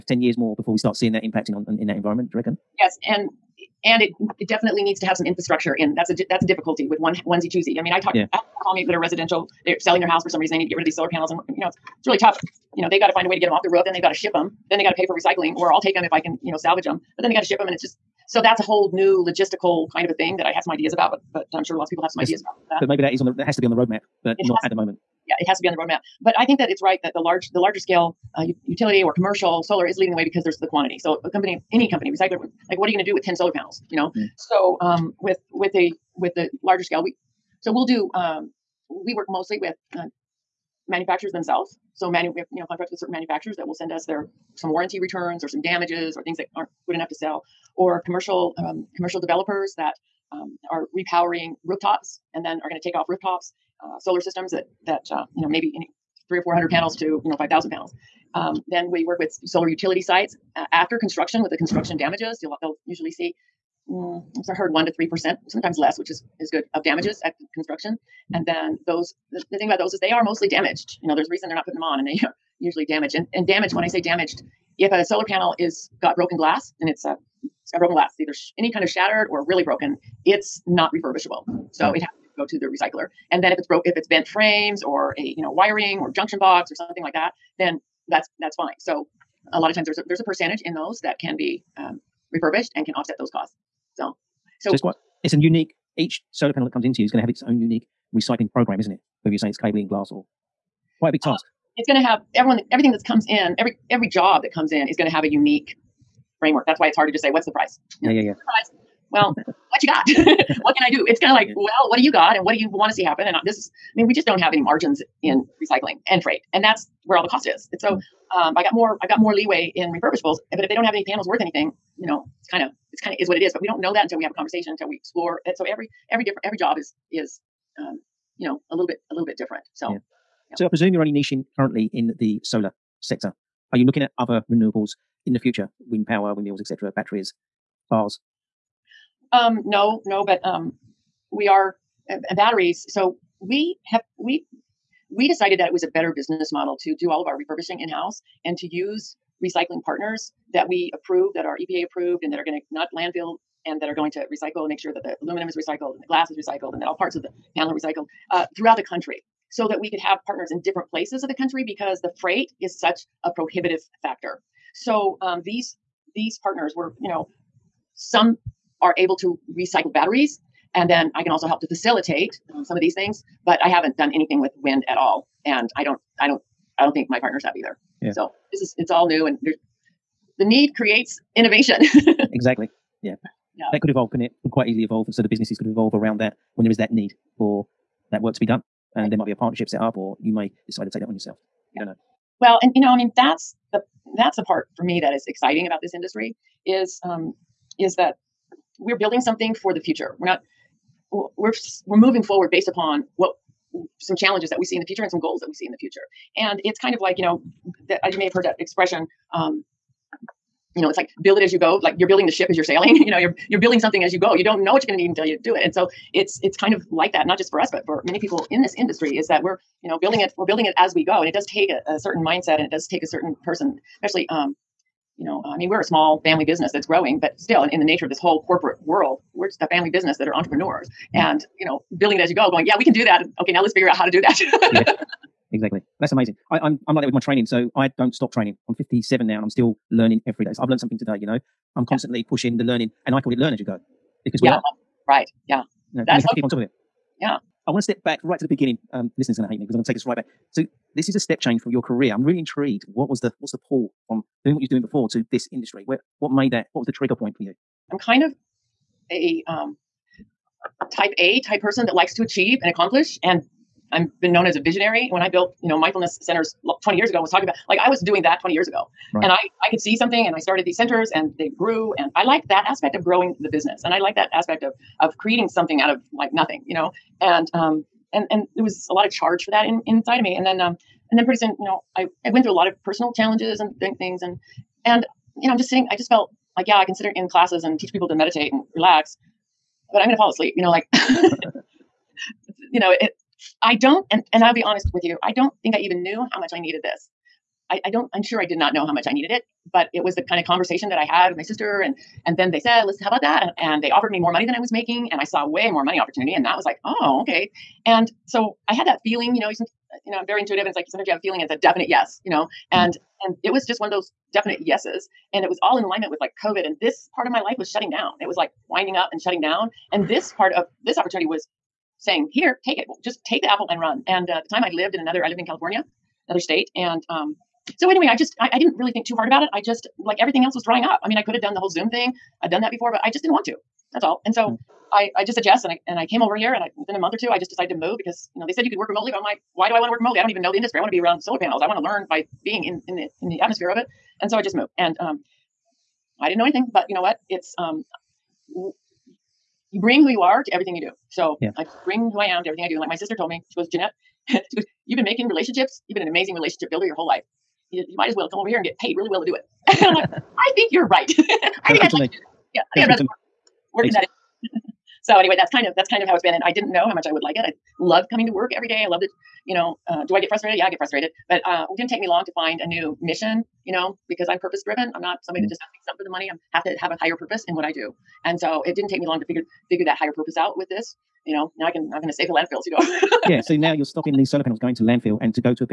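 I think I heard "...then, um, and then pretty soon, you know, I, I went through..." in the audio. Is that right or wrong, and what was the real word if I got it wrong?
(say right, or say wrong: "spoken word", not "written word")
right.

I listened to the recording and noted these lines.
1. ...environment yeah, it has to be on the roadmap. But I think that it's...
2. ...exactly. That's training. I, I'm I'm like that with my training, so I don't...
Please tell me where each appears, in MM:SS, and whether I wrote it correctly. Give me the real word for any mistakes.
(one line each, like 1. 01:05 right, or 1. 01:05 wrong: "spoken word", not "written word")
1. 00:24 wrong: "moment", not "environment"
2. 03:55 wrong: "amazing", not "training".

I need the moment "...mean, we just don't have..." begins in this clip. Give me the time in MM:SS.
01:53.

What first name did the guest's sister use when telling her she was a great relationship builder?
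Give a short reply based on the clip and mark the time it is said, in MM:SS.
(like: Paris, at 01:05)
Janette, at 05:53.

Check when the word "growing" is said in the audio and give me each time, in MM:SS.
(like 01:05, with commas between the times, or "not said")
03:46, 04:33.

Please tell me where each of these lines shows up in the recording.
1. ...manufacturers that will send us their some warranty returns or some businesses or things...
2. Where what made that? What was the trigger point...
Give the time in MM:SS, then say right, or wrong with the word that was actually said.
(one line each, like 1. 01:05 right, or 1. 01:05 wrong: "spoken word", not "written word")
1. 00:43 wrong: "damages", not "businesses"
2. 04:15 right.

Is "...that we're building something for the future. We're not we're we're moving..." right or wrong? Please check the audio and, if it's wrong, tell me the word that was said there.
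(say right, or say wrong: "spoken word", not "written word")
right.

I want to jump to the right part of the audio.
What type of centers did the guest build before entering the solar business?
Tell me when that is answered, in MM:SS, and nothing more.
04:25.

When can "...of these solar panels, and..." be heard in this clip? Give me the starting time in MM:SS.
00:10.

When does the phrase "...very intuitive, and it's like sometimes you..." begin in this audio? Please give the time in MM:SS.
05:10.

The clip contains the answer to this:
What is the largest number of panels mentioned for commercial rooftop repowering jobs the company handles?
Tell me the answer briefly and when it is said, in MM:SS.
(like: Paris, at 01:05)
5,000, at 00:57.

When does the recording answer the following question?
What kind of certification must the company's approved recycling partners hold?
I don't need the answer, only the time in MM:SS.
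02:31.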